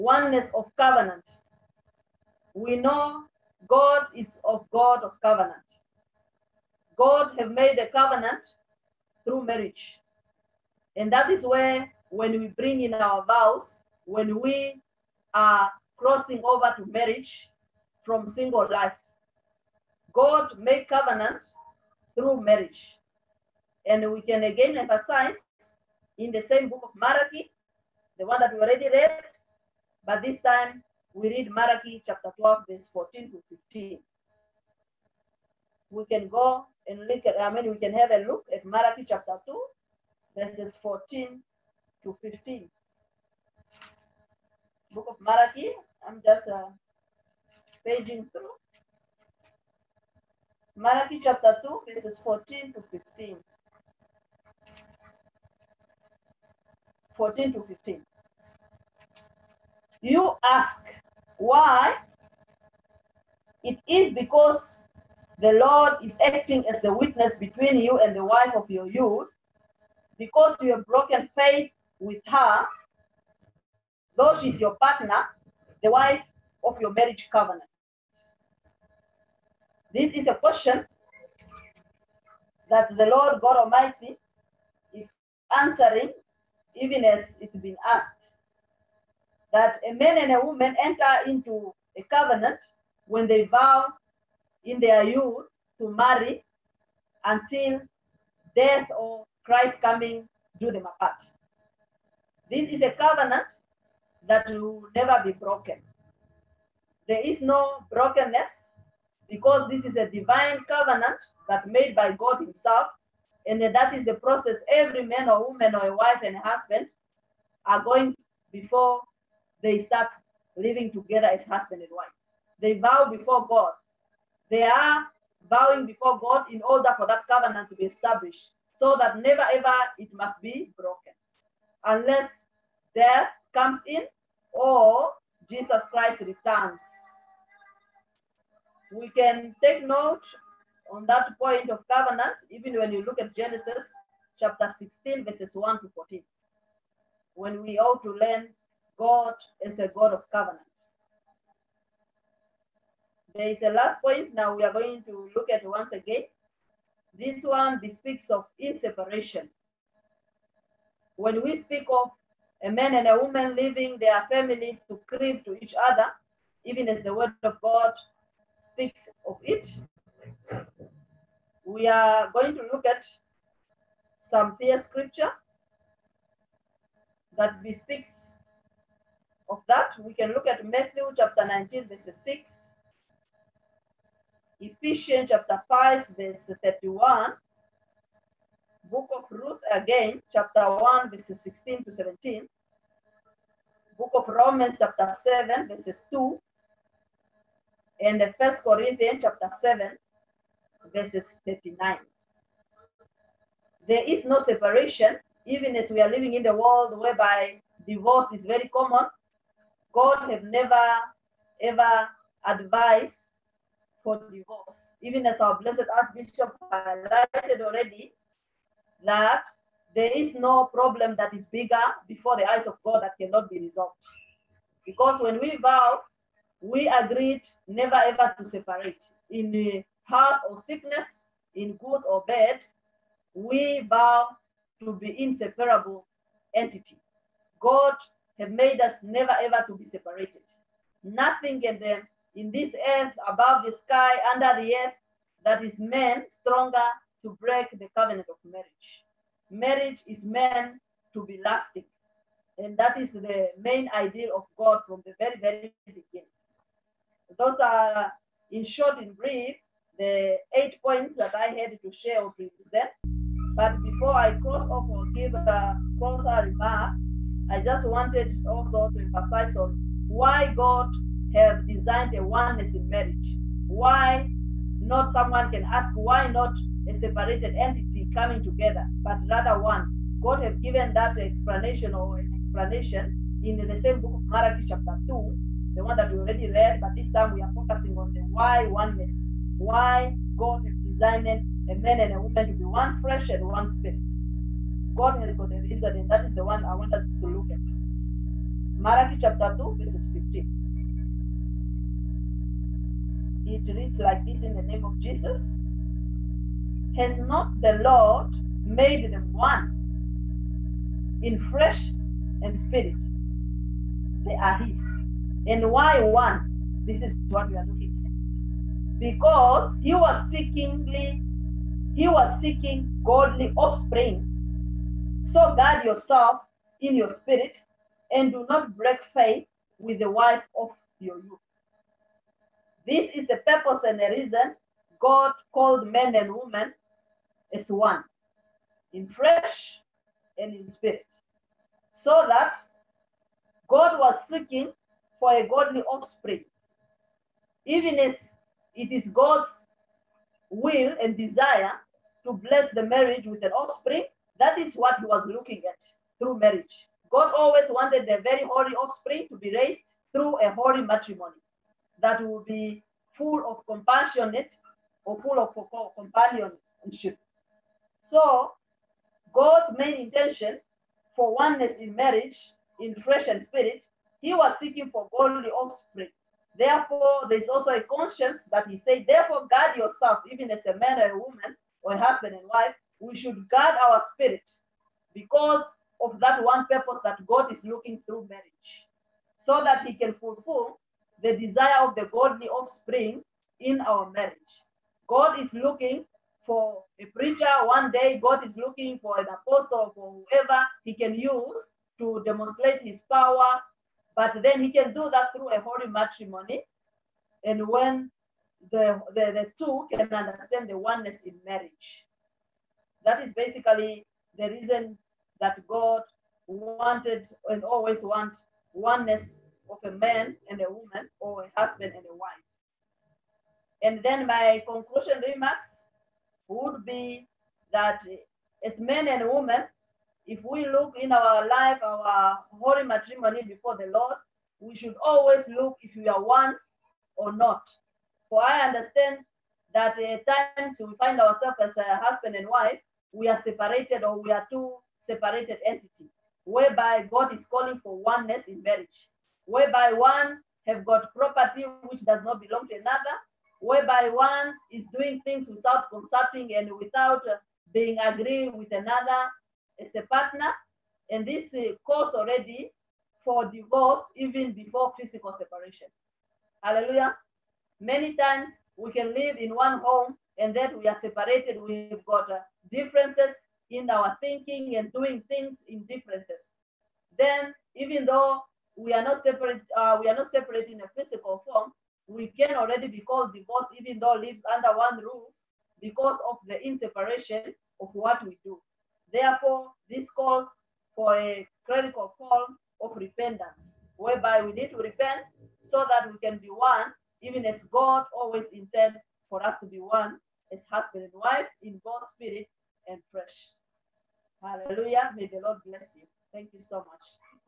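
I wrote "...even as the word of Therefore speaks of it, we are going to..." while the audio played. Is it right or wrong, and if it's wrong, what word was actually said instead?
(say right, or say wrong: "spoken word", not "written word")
wrong: "God", not "Therefore".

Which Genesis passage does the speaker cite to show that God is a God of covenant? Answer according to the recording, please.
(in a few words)
Genesis 16:1-14.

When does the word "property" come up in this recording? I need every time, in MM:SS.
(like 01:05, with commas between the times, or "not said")
07:31.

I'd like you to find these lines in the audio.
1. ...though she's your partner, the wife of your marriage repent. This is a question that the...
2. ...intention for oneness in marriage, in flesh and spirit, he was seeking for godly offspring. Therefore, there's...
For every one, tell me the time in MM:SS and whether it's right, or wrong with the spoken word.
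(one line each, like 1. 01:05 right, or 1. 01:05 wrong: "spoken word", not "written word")
1. 01:14 wrong: "covenant", not "repent"
2. 06:09 right.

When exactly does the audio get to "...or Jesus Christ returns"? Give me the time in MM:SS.
02:14.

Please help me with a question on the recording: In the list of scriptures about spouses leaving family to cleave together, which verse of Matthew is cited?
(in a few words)
Matthew 19:6.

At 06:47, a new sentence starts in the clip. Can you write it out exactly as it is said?
And when the, the, the two can understand the oneness in marriage.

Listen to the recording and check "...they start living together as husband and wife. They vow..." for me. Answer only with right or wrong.
right.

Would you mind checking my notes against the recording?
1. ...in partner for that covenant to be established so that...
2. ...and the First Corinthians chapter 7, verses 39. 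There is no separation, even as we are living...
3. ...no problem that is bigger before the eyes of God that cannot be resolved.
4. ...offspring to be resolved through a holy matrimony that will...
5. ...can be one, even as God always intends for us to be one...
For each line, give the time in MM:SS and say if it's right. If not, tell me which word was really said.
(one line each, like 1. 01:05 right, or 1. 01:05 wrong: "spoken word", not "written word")
1. 02:06 wrong: "order", not "partner"
2. 03:17 right
3. 03:40 right
4. 05:58 wrong: "raised", not "resolved"
5. 08:16 right.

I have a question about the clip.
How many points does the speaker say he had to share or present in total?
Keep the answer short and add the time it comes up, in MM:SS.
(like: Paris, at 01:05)
8, at 04:20.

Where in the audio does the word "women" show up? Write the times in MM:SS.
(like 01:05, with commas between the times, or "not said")
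05:36, 07:09.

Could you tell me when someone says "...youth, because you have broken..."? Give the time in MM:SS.
01:08.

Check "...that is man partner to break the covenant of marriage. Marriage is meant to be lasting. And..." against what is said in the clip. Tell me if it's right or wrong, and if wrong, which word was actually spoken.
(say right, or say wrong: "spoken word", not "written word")
wrong: "stronger", not "partner".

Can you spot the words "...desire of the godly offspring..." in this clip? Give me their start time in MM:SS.
06:31.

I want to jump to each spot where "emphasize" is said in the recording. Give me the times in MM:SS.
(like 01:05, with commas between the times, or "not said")
00:24, 04:29.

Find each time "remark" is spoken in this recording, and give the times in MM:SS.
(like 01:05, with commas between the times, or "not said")
04:26, 07:05.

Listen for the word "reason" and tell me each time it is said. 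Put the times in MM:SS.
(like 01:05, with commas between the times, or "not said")
04:55, 05:34, 06:54.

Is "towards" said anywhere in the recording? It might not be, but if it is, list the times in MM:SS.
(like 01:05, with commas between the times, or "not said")
not said.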